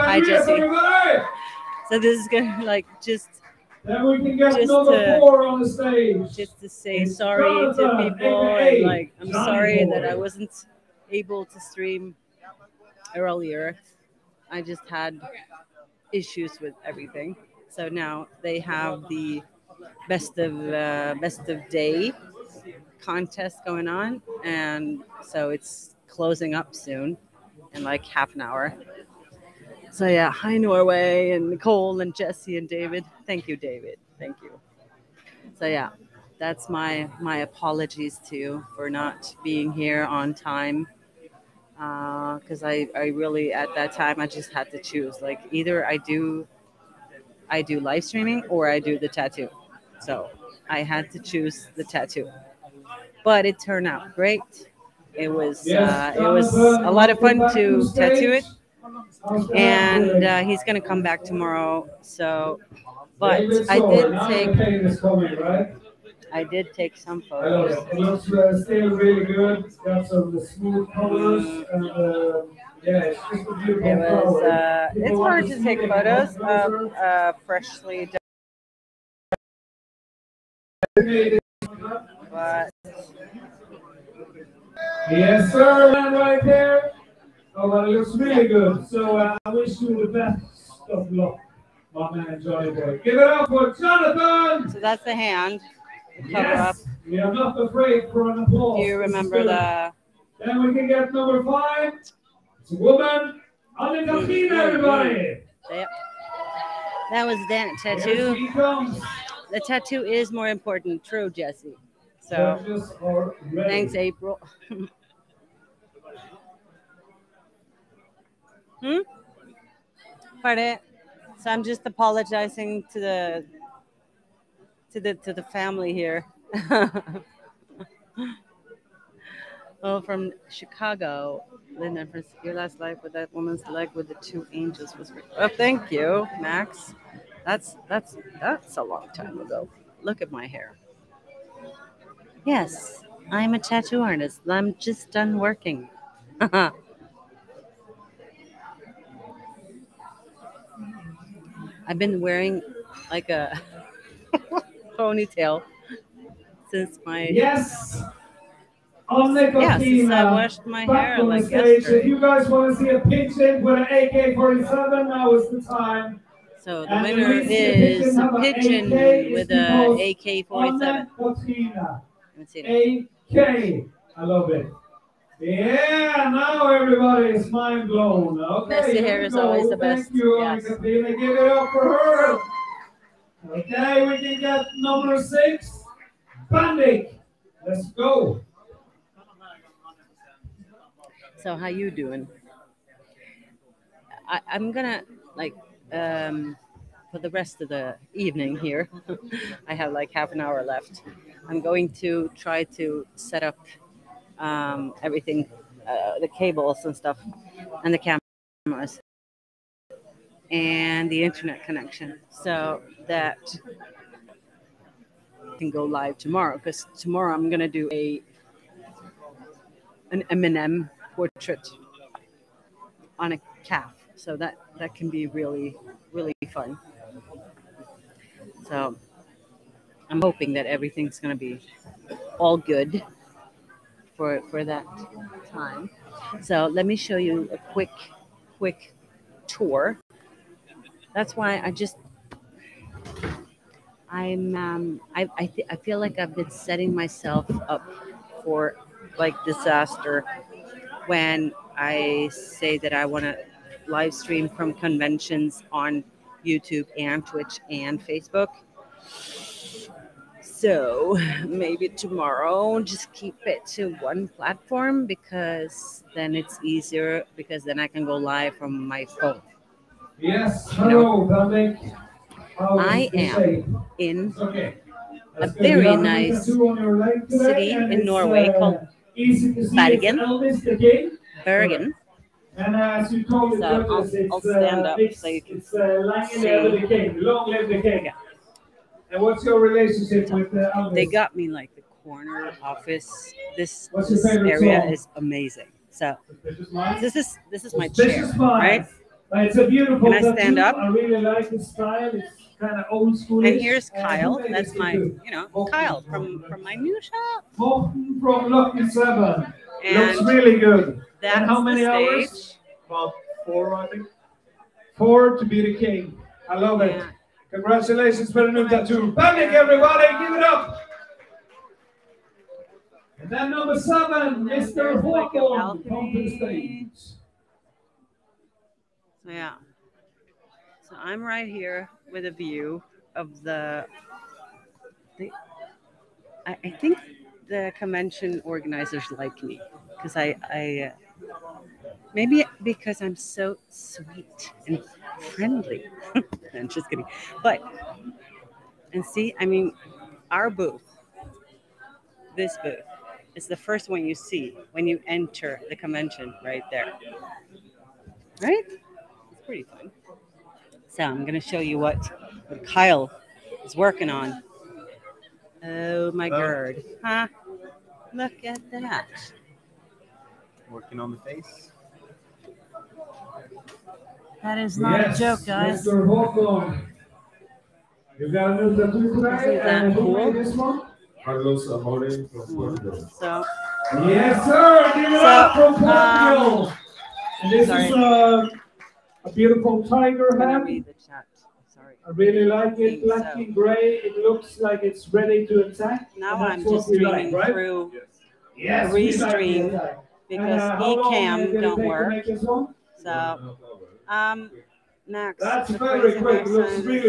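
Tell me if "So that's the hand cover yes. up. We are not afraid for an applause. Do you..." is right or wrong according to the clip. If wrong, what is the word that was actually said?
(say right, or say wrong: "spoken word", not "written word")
right.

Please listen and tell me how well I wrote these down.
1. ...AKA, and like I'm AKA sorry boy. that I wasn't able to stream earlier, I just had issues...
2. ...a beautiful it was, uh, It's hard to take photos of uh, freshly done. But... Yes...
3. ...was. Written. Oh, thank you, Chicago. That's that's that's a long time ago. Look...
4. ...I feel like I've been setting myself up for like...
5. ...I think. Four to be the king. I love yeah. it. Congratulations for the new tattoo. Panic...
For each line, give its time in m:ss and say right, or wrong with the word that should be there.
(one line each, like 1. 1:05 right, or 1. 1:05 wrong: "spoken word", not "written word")
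1. 0:08 wrong: "Johnny", not "AKA"
2. 1:13 right
3. 2:14 wrong: "Max", not "Chicago"
4. 4:05 right
5. 5:13 right.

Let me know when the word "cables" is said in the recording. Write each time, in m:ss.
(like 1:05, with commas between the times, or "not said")
3:26.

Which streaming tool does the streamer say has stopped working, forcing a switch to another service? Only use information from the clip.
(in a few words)
Ecamm.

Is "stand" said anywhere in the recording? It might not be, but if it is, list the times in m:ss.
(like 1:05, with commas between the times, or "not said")
4:44, 5:00.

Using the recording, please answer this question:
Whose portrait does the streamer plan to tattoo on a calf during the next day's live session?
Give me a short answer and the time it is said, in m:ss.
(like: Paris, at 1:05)
Eminem, at 3:40.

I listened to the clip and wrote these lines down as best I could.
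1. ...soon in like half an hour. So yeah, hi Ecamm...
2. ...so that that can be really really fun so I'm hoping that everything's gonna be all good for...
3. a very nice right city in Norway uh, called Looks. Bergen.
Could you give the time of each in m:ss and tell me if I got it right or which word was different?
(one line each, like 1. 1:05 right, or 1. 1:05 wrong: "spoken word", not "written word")
1. 0:26 wrong: "Norway", not "Ecamm"
2. 3:44 right
3. 4:35 wrong: "Bergen", not "Looks".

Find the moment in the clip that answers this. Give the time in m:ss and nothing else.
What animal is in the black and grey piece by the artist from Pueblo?
6:29.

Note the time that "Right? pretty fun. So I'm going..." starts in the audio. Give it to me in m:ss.
5:58.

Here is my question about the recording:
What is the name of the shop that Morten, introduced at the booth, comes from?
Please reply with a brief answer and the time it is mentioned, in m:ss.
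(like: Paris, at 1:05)
Lucky Seven, at 5:08.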